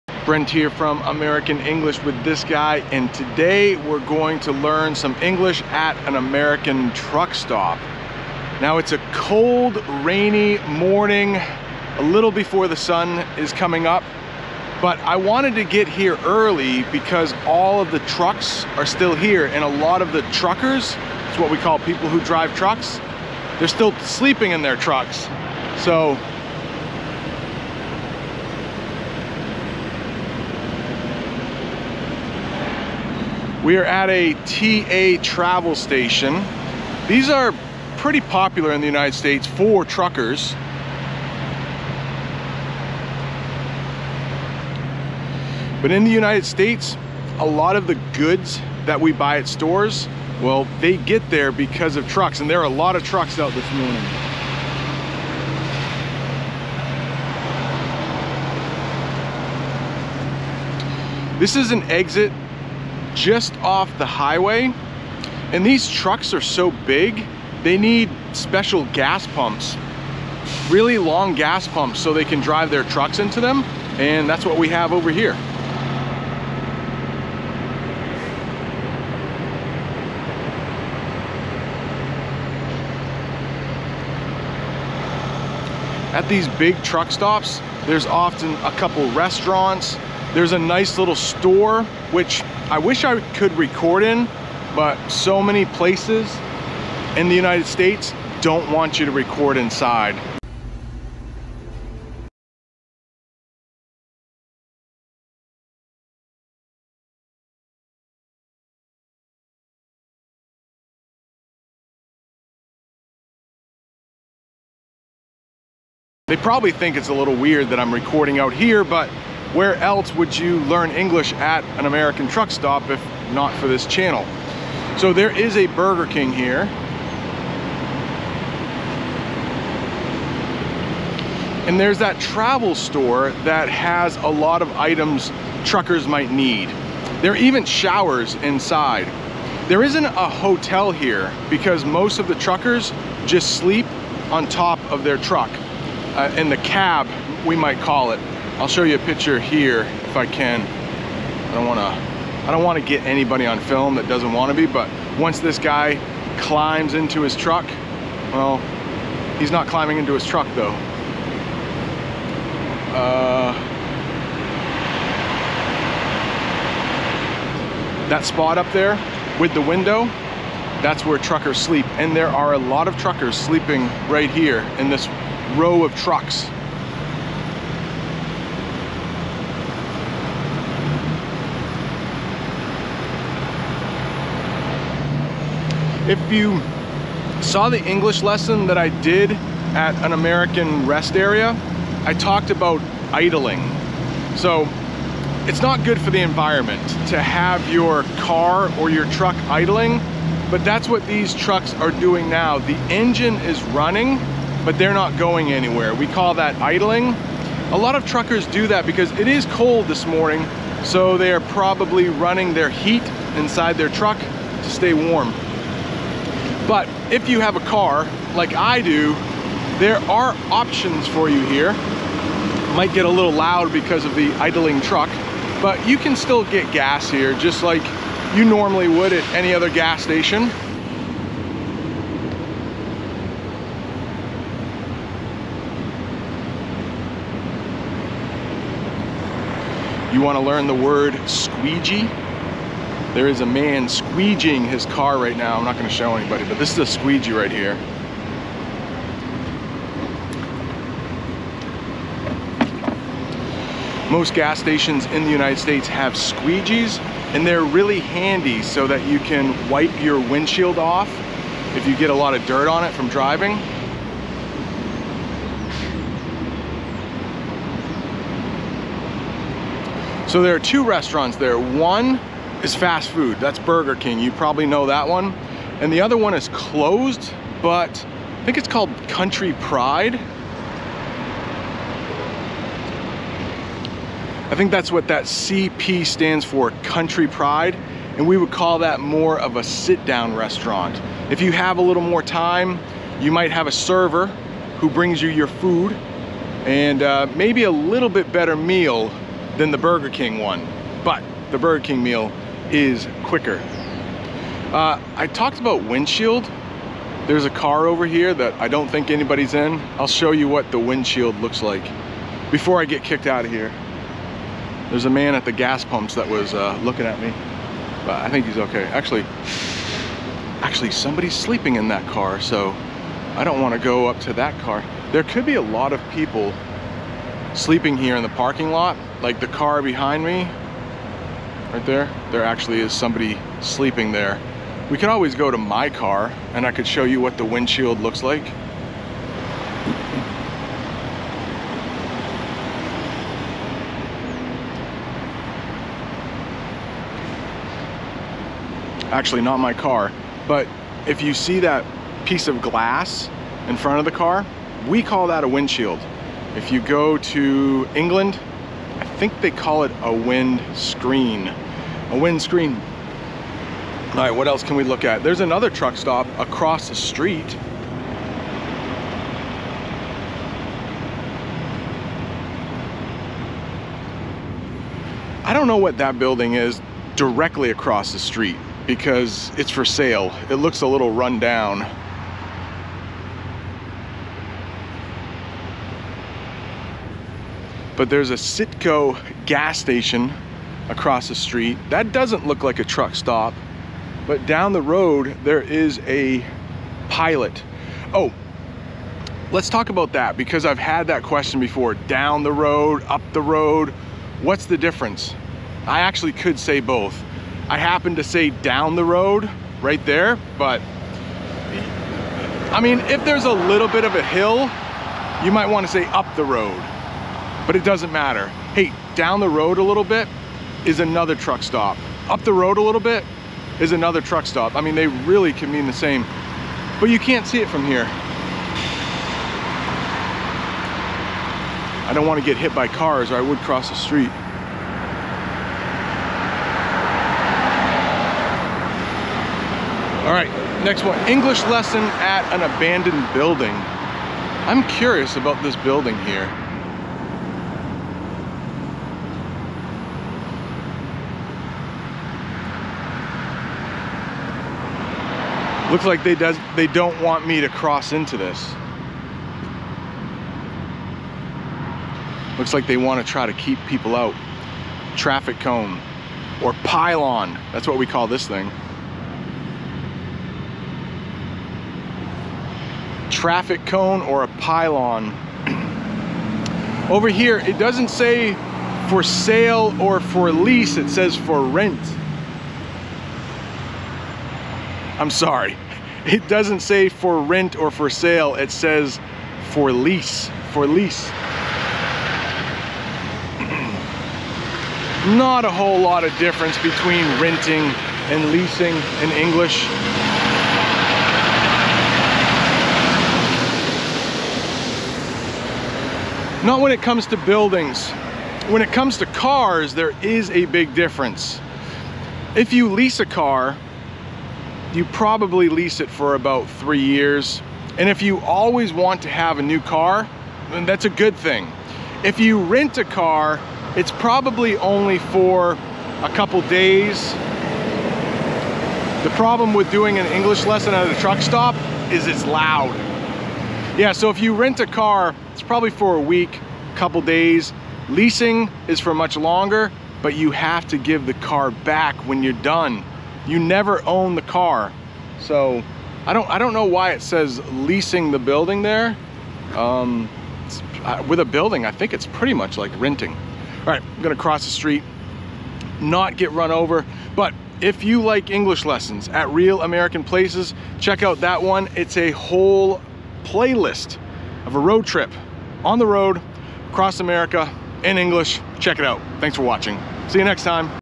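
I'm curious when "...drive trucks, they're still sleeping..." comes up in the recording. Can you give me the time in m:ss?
0:22.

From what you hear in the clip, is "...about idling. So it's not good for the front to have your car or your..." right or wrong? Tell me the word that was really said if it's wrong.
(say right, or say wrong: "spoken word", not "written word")
wrong: "environment", not "front".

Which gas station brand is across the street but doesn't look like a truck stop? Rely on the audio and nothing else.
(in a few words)
Citgo.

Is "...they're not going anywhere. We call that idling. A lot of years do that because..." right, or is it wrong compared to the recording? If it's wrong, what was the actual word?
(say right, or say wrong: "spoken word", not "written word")
wrong: "truckers", not "years".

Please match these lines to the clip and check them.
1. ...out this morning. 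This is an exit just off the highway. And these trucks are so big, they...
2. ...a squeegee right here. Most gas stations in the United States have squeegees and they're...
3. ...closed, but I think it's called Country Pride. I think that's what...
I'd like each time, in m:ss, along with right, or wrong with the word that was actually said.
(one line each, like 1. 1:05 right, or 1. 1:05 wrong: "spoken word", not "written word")
1. 0:53 right
2. 4:06 right
3. 4:36 right.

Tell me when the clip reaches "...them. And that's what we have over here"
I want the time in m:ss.
1:13.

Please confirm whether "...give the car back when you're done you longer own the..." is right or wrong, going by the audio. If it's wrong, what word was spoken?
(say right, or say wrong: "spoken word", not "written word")
wrong: "never", not "longer".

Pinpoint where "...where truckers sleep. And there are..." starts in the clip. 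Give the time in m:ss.
2:51.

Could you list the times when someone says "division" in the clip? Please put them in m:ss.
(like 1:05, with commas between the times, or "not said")
not said.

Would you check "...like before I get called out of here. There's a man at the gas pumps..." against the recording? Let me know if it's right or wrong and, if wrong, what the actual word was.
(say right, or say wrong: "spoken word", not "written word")
wrong: "kicked", not "called".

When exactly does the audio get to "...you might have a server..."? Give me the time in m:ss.
4:53.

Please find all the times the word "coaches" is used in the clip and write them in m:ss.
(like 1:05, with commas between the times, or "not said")
not said.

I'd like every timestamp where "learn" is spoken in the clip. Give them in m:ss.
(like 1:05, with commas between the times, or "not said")
0:04, 2:00, 4:00.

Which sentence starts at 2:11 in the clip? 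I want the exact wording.
And there's that travel store that has a lot of items truckers might need.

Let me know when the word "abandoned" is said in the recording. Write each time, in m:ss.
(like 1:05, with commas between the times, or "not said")
7:22.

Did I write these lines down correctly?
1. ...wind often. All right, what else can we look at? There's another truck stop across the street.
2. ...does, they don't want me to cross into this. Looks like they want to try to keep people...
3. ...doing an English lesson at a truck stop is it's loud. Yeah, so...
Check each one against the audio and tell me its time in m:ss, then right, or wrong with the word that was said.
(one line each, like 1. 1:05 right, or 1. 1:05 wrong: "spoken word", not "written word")
1. 6:02 wrong: "screen", not "often"
2. 7:36 right
3. 8:49 right.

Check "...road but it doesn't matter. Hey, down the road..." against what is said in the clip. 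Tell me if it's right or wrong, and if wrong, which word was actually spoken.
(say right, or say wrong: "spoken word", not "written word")
right.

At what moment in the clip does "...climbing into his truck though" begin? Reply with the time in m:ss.
2:39.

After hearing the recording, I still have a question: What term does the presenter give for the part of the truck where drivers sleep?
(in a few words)
the cab.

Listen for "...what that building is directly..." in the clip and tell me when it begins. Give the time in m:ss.
6:15.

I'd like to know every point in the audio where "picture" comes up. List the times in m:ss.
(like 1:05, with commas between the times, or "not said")
2:28.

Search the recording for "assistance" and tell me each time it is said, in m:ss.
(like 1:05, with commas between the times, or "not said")
not said.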